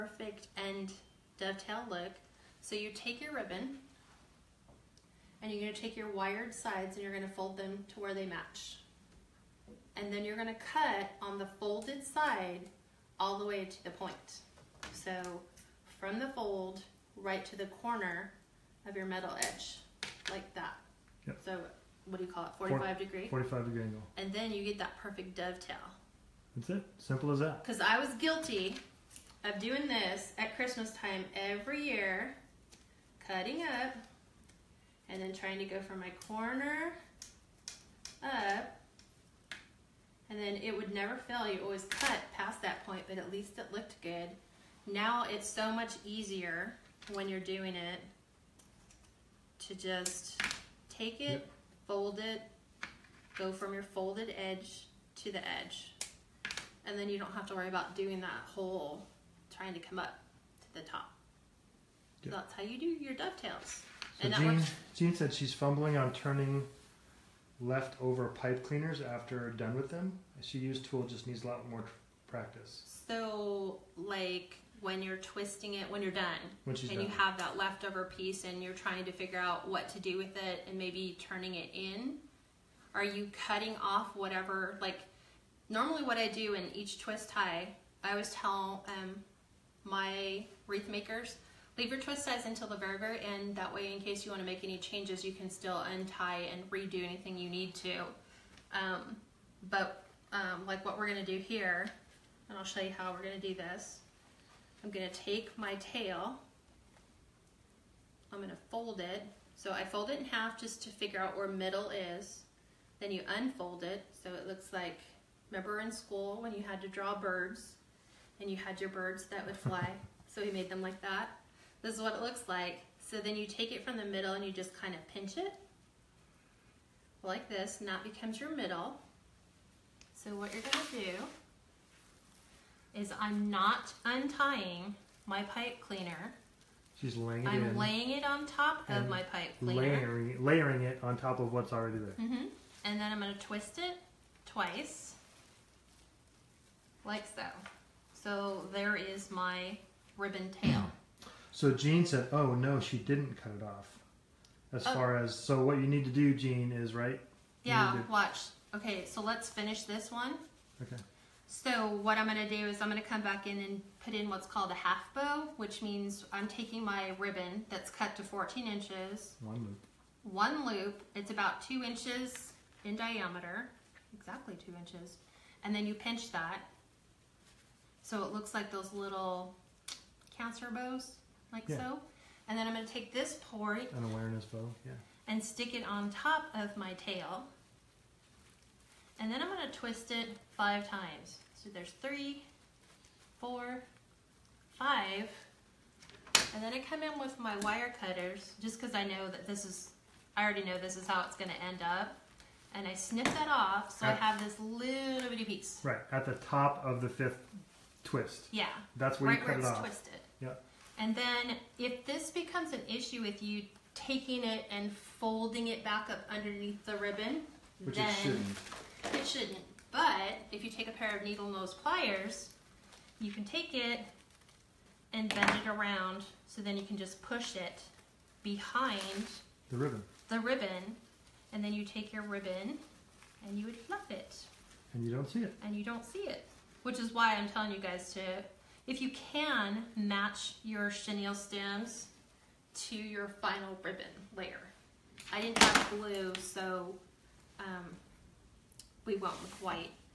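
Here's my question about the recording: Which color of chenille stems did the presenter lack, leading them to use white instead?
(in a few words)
Blue.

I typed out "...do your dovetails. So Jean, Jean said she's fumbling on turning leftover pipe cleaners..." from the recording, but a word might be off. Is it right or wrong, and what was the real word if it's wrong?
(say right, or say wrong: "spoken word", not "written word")
right.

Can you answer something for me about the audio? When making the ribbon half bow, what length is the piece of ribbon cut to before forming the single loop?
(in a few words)
14 inches.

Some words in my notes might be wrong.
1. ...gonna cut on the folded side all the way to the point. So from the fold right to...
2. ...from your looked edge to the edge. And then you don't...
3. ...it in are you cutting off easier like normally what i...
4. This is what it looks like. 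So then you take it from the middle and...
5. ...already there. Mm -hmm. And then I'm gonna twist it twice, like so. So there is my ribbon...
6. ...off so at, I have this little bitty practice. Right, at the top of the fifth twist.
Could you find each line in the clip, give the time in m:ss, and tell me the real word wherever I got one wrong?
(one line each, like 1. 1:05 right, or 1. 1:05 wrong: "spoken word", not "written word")
1. 0:10 right
2. 0:53 wrong: "folded", not "looked"
3. 1:21 wrong: "whatever", not "easier"
4. 2:01 right
5. 2:21 right
6. 3:23 wrong: "piece", not "practice".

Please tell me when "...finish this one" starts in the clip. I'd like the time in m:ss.
2:39.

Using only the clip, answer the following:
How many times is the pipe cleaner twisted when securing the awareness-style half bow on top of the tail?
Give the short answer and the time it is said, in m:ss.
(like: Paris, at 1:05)
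5, at 3:10.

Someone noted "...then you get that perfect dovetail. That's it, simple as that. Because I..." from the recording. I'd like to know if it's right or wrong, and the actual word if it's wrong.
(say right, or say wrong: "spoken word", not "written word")
right.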